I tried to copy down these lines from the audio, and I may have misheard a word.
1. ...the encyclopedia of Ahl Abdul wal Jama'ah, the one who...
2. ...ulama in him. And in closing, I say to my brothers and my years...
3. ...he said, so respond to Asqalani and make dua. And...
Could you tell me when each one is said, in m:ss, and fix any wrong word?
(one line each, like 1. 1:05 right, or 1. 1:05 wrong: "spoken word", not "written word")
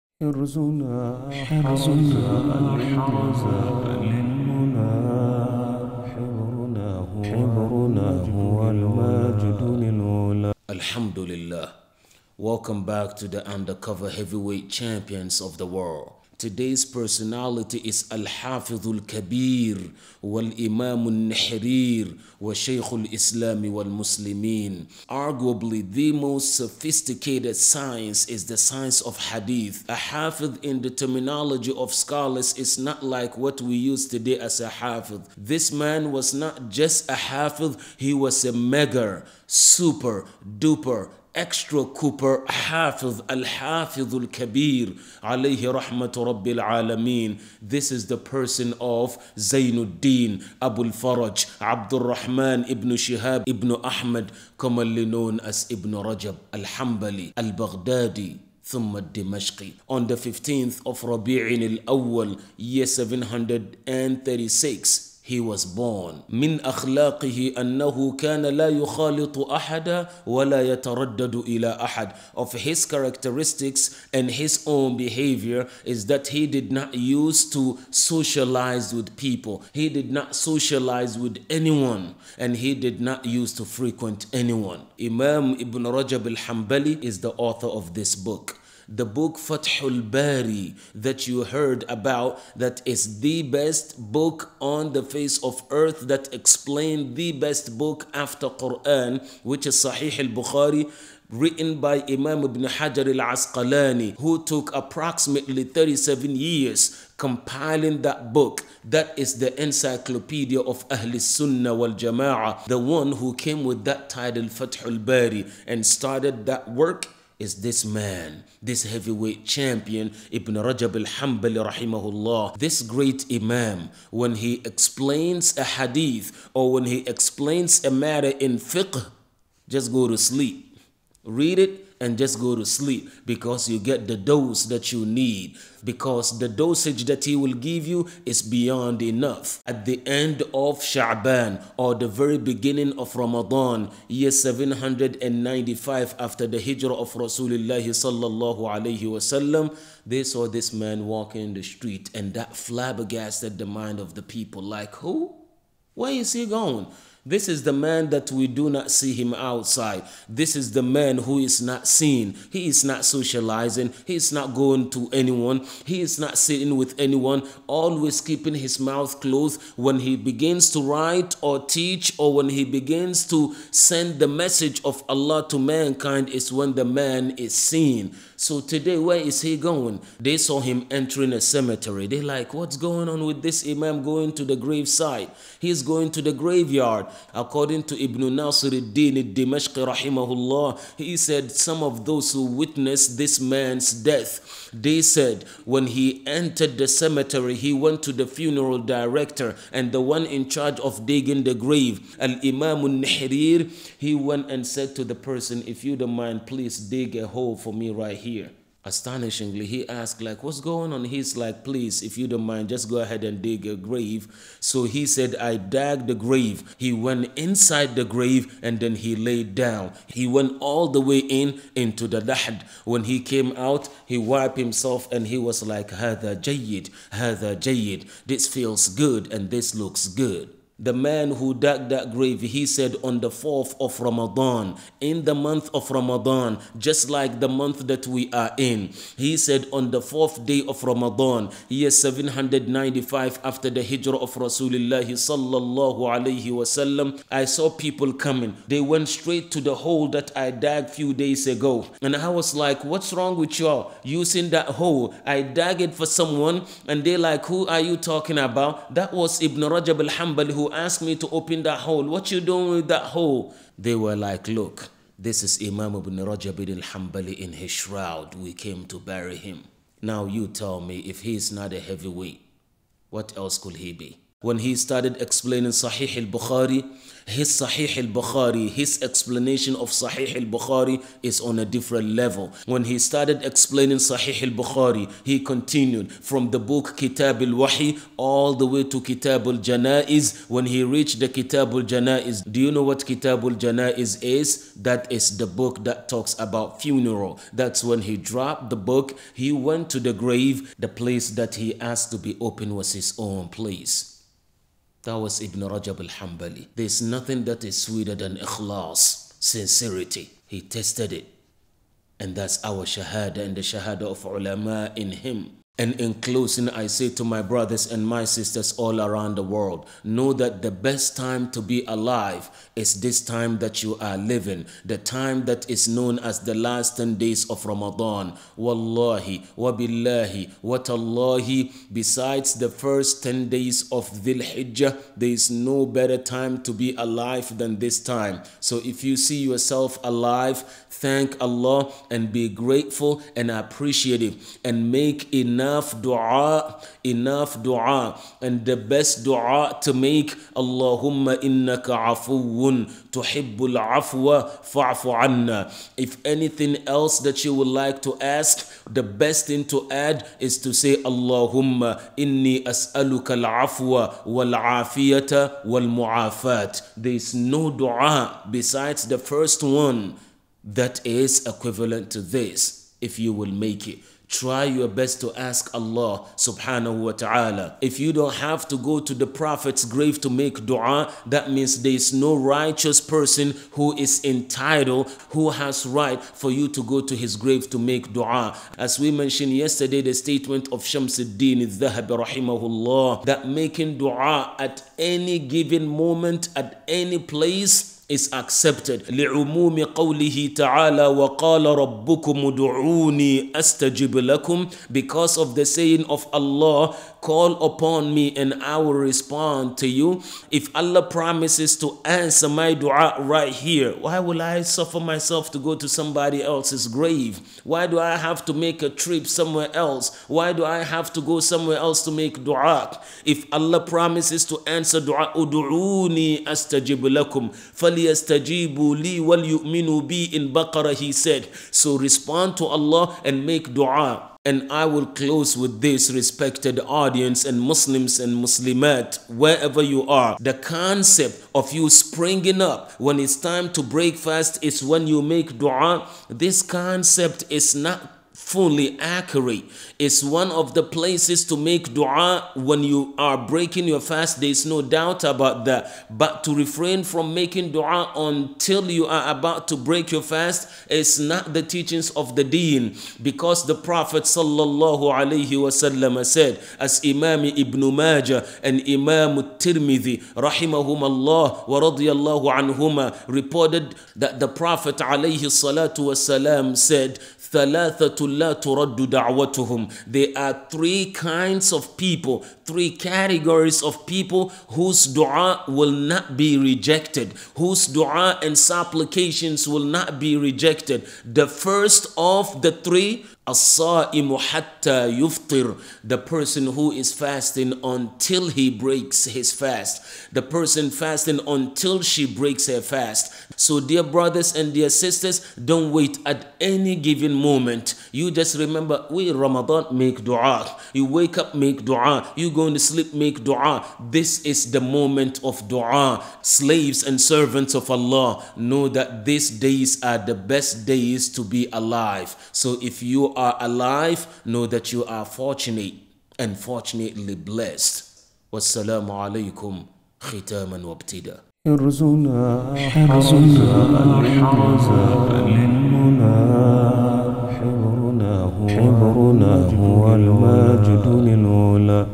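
1. 1:49 wrong: "Sunnah", not "Abdul"
2. 5:14 wrong: "sisters", not "years"
3. 7:10 wrong: "Allah", not "Asqalani".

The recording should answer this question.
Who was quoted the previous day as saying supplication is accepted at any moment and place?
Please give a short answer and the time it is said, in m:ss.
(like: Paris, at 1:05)
Shamsuddin al-Dhahabi, at 6:30.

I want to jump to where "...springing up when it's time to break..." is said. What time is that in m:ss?
7:21.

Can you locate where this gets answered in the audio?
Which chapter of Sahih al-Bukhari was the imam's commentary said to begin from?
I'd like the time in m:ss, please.
4:46.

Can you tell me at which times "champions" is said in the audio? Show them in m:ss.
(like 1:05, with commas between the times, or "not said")
0:14, 1:59.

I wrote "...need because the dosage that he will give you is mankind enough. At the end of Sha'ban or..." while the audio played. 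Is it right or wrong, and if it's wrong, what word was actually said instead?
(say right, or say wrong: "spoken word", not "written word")
wrong: "beyond", not "mankind".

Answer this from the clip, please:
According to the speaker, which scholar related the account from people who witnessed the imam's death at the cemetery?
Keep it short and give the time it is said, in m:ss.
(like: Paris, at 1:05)
Ibn Nasir al-Din al-Dimashqi, at 3:08.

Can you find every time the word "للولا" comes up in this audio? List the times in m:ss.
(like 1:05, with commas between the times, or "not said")
0:09.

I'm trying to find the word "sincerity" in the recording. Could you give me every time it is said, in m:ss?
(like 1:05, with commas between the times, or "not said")
5:09.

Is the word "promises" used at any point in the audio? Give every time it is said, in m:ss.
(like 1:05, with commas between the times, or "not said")
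6:51, 7:03.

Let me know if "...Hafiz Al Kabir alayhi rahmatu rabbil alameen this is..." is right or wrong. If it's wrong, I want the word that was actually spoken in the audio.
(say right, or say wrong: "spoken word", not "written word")
right.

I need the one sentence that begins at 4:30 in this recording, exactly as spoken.
Now you tell me if he is not a heavyweight, what else could he be?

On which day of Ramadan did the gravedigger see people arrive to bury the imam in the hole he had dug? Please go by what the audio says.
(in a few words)
4th.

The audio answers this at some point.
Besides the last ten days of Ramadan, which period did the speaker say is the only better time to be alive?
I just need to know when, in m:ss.
5:32.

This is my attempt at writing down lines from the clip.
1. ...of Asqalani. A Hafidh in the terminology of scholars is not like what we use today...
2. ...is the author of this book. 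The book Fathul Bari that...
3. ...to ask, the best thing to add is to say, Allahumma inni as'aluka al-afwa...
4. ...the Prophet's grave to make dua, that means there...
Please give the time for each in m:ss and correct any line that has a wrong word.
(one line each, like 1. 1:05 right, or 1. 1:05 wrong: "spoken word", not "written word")
1. 0:29 wrong: "Hadith", not "Asqalani"
2. 1:27 right
3. 5:58 right
4. 6:19 right.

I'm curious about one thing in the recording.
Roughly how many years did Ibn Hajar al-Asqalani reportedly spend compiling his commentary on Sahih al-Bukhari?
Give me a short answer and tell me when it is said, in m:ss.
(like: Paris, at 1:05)
37, at 1:45.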